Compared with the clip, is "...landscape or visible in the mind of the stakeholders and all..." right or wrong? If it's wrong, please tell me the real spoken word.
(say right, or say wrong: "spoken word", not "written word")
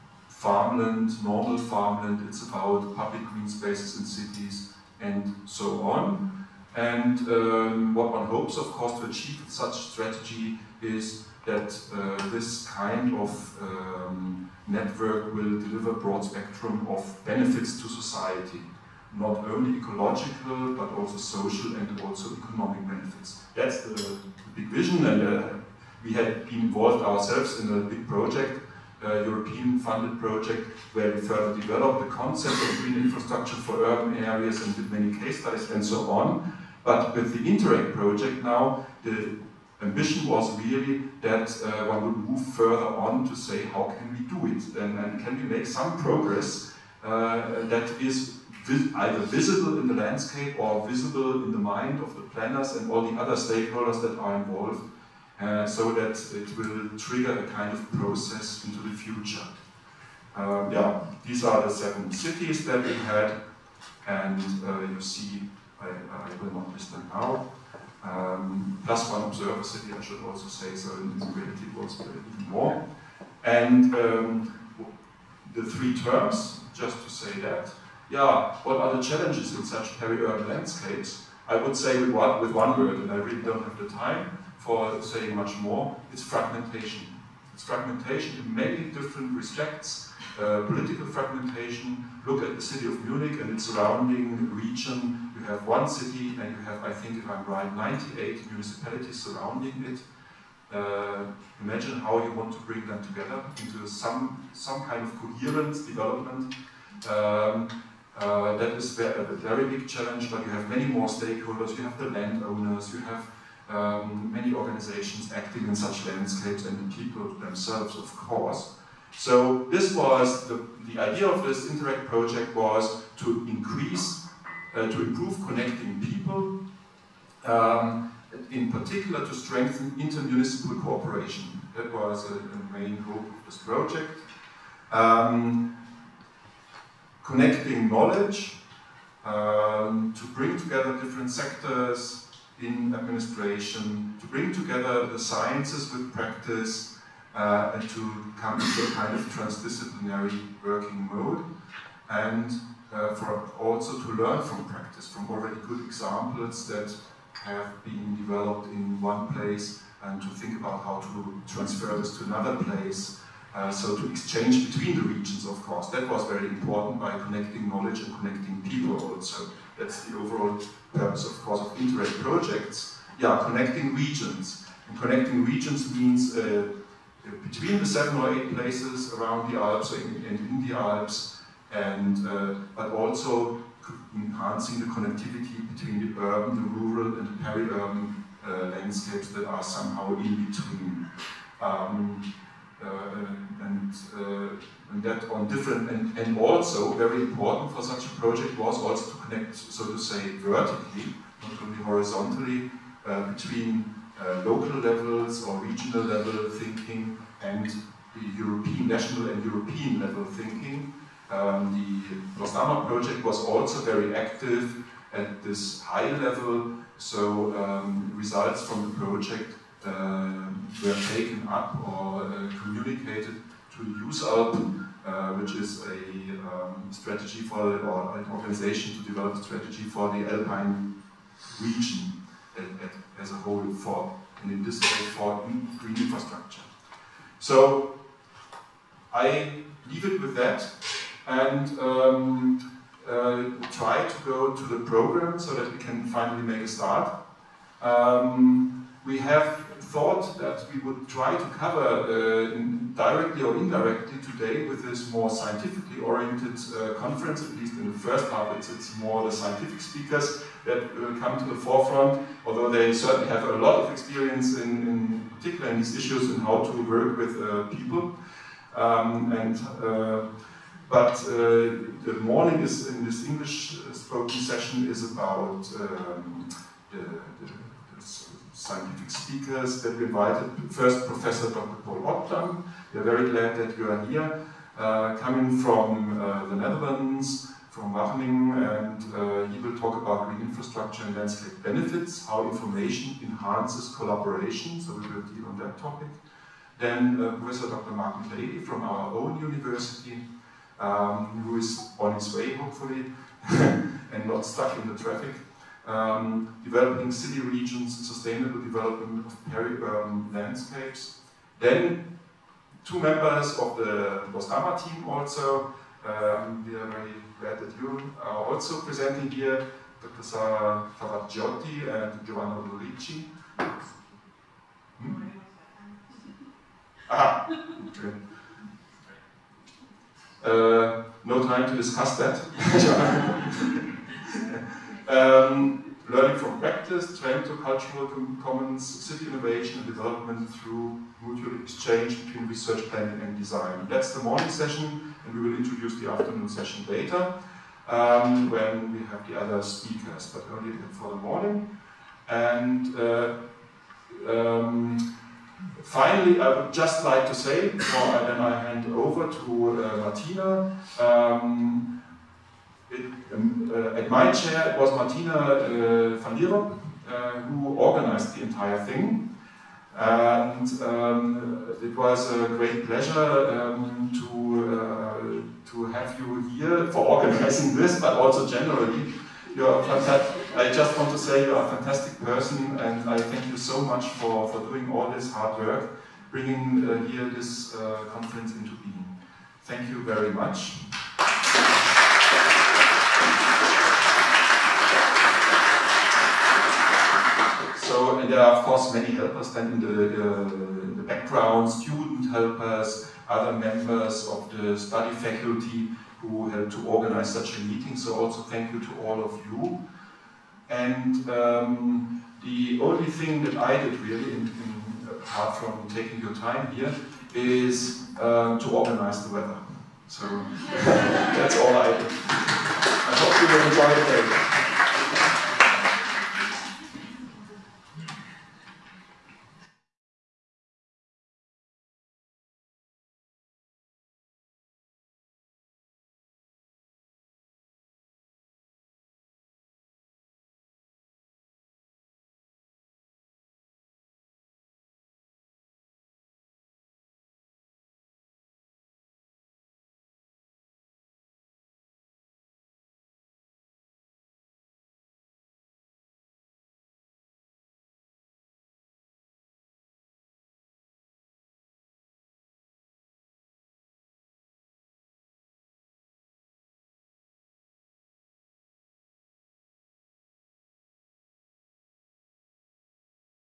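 wrong: "planners", not "stakeholders".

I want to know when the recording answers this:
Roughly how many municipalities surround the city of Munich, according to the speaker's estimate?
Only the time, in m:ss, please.
1:37.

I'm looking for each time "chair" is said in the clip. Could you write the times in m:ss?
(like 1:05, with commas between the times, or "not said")
6:04.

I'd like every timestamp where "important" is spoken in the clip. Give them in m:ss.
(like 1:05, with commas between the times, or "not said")
2:46, 3:17.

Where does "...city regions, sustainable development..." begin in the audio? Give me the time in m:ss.
5:07.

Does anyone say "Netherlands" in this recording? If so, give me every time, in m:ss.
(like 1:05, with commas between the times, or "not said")
4:46.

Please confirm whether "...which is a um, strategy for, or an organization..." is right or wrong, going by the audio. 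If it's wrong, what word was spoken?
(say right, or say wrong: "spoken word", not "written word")
right.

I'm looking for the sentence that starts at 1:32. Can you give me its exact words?
Look at the city of Munich and its surrounding region.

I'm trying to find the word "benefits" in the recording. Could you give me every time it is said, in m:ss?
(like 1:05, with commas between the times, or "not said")
0:17, 0:22, 4:51.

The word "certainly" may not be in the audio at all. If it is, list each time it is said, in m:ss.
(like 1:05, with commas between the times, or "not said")
4:22.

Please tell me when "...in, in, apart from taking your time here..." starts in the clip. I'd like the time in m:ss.
6:54.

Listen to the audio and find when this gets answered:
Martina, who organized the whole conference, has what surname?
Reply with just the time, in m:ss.
6:06.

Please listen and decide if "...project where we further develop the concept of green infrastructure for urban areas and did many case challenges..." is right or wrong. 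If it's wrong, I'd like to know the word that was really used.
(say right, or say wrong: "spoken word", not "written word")
wrong: "studies", not "challenges".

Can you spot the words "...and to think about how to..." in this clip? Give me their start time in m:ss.
2:40.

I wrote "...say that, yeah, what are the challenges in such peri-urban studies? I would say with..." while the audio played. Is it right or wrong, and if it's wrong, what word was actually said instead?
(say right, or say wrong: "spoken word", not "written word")
wrong: "landscapes", not "studies".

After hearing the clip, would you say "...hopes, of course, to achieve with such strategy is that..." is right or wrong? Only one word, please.
right.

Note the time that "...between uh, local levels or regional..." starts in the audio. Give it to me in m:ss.
3:23.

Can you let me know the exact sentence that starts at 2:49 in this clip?
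That's the overall purpose, of course, of interreg projects, yeah, connecting regions.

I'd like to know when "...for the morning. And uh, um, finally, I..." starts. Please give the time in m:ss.
5:50.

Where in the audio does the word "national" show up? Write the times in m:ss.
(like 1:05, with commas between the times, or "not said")
3:28.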